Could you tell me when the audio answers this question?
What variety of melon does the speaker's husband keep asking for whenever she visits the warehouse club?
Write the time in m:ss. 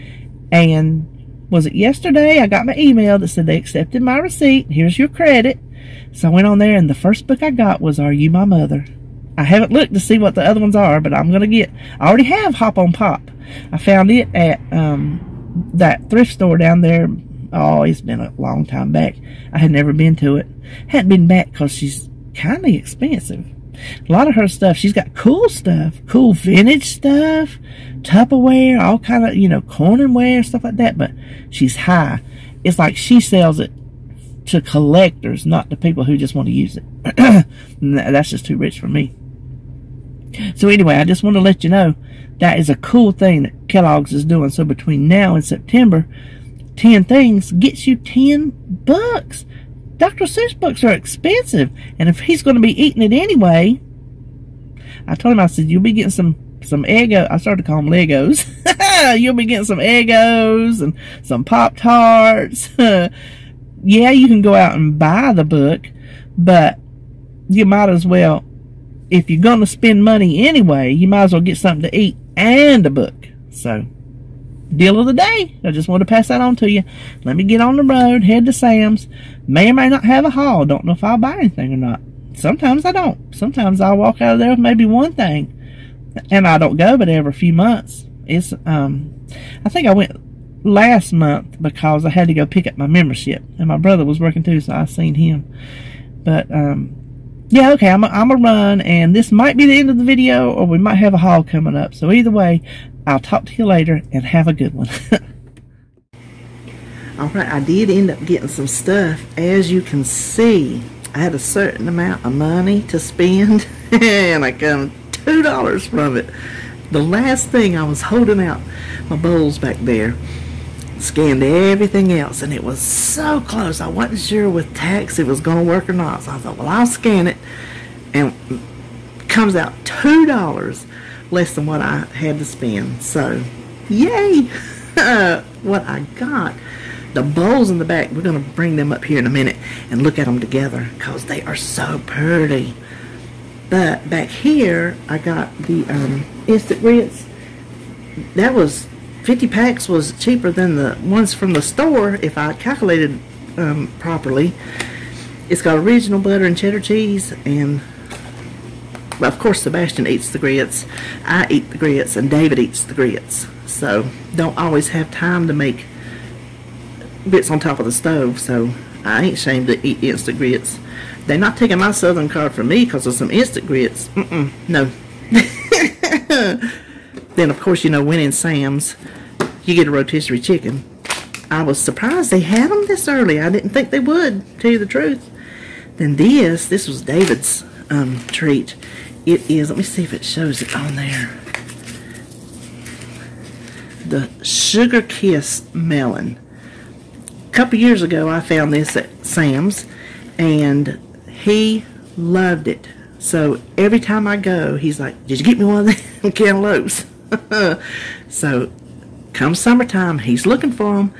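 3:14.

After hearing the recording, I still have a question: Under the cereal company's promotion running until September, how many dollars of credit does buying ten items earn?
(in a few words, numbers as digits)
$10.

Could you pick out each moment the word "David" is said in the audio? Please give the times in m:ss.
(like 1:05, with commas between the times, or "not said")
2:42, 3:07.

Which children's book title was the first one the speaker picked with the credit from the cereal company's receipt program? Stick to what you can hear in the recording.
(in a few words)
Are You My Mother?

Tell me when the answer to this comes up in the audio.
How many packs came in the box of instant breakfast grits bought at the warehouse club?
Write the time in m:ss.
2:29.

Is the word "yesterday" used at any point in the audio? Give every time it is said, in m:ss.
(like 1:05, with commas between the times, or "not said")
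0:01.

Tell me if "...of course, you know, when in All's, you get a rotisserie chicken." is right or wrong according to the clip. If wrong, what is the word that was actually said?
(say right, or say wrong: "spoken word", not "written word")
wrong: "Sam", not "All".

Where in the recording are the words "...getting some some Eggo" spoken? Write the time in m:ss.
0:55.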